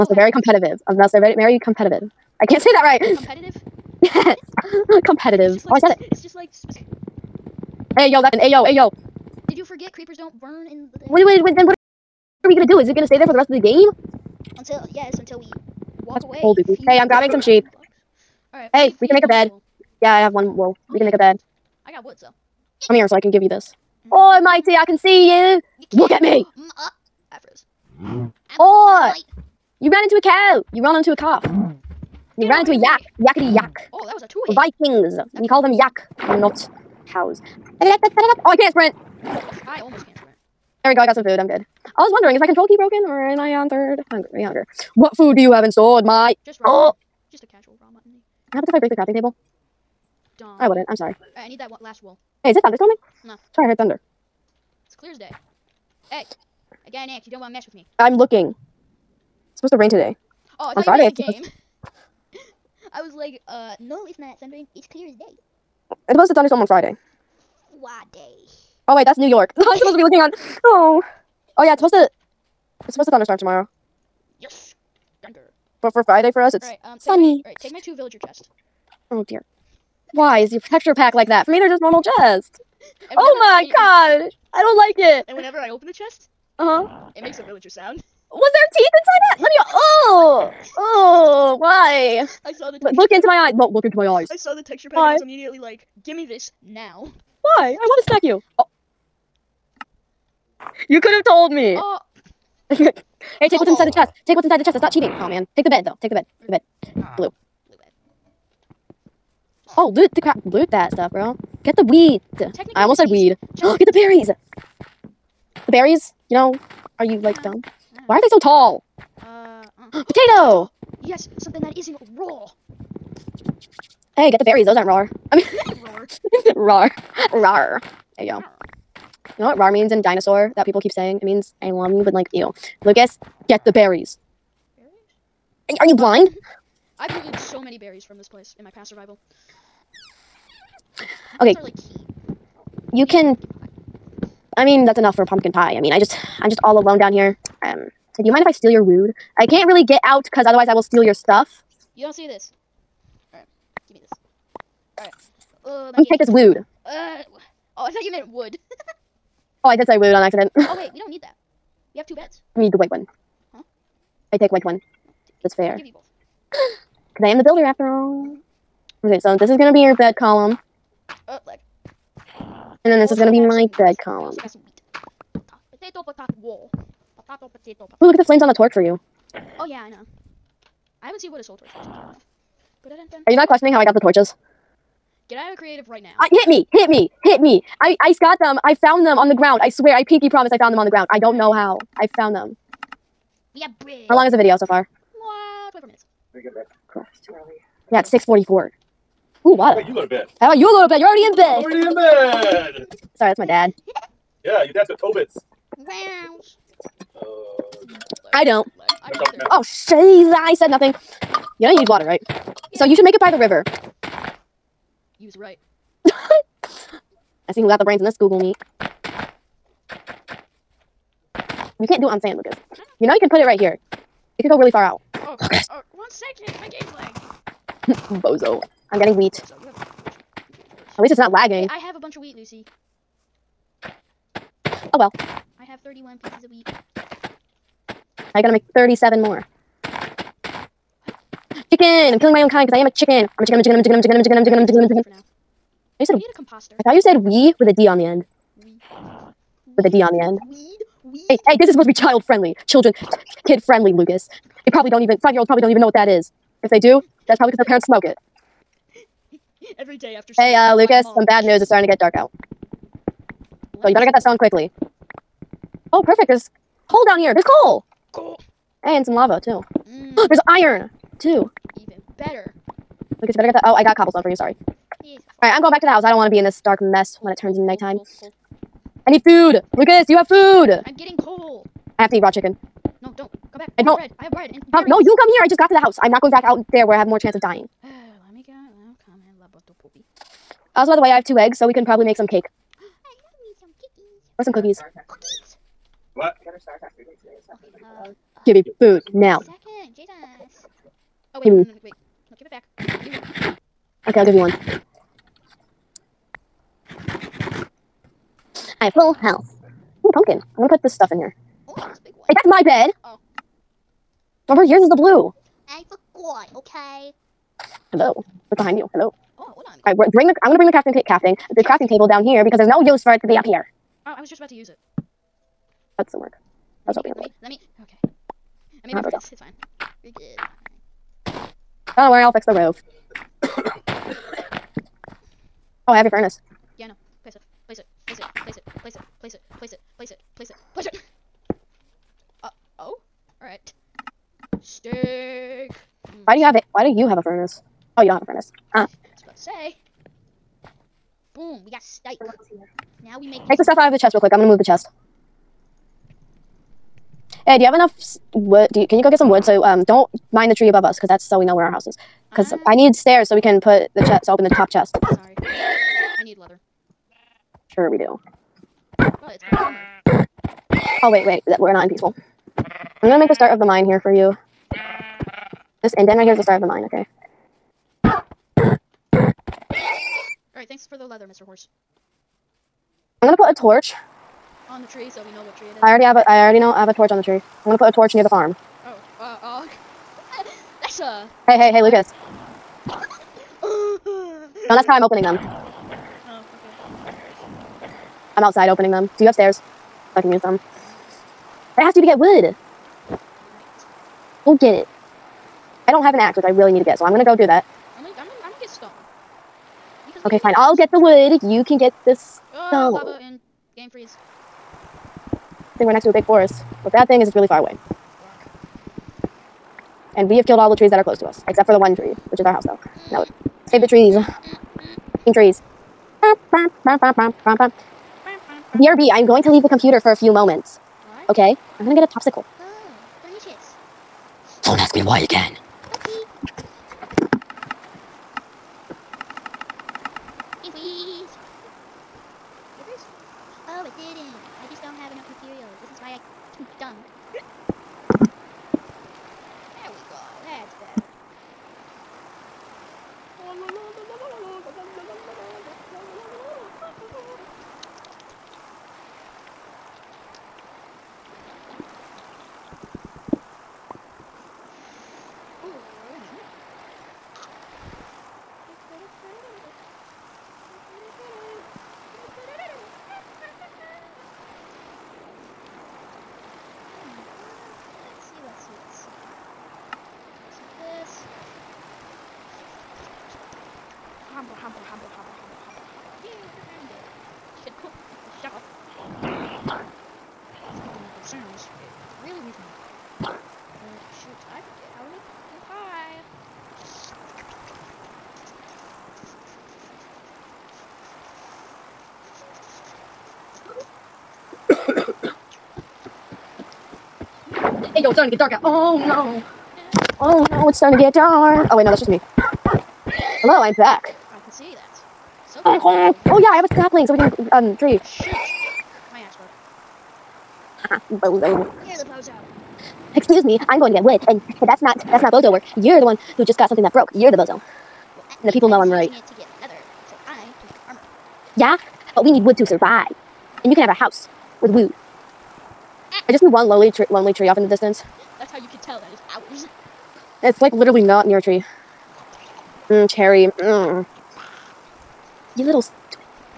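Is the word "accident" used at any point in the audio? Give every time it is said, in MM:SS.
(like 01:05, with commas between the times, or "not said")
02:40.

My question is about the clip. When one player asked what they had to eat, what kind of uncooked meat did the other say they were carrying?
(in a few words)
raw mutton.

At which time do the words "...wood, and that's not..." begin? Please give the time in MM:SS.
08:44.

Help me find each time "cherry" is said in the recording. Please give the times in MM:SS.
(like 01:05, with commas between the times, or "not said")
09:03.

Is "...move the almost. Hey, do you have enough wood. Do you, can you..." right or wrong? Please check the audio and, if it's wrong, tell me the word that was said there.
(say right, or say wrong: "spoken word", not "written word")
wrong: "chest", not "almost".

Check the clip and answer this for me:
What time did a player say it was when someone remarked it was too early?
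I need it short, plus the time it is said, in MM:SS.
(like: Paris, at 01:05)
6:44, at 03:18.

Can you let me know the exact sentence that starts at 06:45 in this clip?
I don't have an axe, which I really need to get, so I'm gonna go do that.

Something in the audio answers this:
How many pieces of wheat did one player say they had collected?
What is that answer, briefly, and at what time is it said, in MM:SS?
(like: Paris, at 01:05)
31, at 03:55.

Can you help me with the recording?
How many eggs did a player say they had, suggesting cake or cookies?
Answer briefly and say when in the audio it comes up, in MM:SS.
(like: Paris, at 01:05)
2, at 04:51.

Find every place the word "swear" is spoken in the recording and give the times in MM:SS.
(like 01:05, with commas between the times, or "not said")
03:09.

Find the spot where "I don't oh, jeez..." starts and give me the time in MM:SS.
03:29.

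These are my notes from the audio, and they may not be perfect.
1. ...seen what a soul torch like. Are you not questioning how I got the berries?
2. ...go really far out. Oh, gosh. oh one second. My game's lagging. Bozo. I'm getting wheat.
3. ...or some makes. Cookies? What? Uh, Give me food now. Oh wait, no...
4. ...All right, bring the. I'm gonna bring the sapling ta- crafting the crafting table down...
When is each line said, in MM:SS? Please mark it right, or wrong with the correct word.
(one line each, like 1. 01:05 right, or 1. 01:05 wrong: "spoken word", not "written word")
1. 03:01 wrong: "torches", not "berries"
2. 03:44 right
3. 04:54 wrong: "cookies", not "makes"
4. 05:19 wrong: "crafting", not "sapling".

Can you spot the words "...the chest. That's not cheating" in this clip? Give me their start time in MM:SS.
01:44.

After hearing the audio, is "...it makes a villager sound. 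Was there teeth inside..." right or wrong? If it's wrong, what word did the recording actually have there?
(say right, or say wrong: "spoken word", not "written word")
right.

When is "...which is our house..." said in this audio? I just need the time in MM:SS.
07:02.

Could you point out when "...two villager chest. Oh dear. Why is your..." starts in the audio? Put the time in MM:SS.
01:17.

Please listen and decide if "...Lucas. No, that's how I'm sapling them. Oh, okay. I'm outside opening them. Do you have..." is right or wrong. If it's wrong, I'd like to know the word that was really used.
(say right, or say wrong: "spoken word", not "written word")
wrong: "opening", not "sapling".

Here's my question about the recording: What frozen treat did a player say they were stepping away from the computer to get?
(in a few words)
a popsicle.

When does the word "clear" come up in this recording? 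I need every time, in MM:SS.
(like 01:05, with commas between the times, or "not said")
00:54, 01:04.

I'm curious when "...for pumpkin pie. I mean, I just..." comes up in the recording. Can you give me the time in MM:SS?
02:25.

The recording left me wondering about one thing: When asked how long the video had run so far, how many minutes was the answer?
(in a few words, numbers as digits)
24.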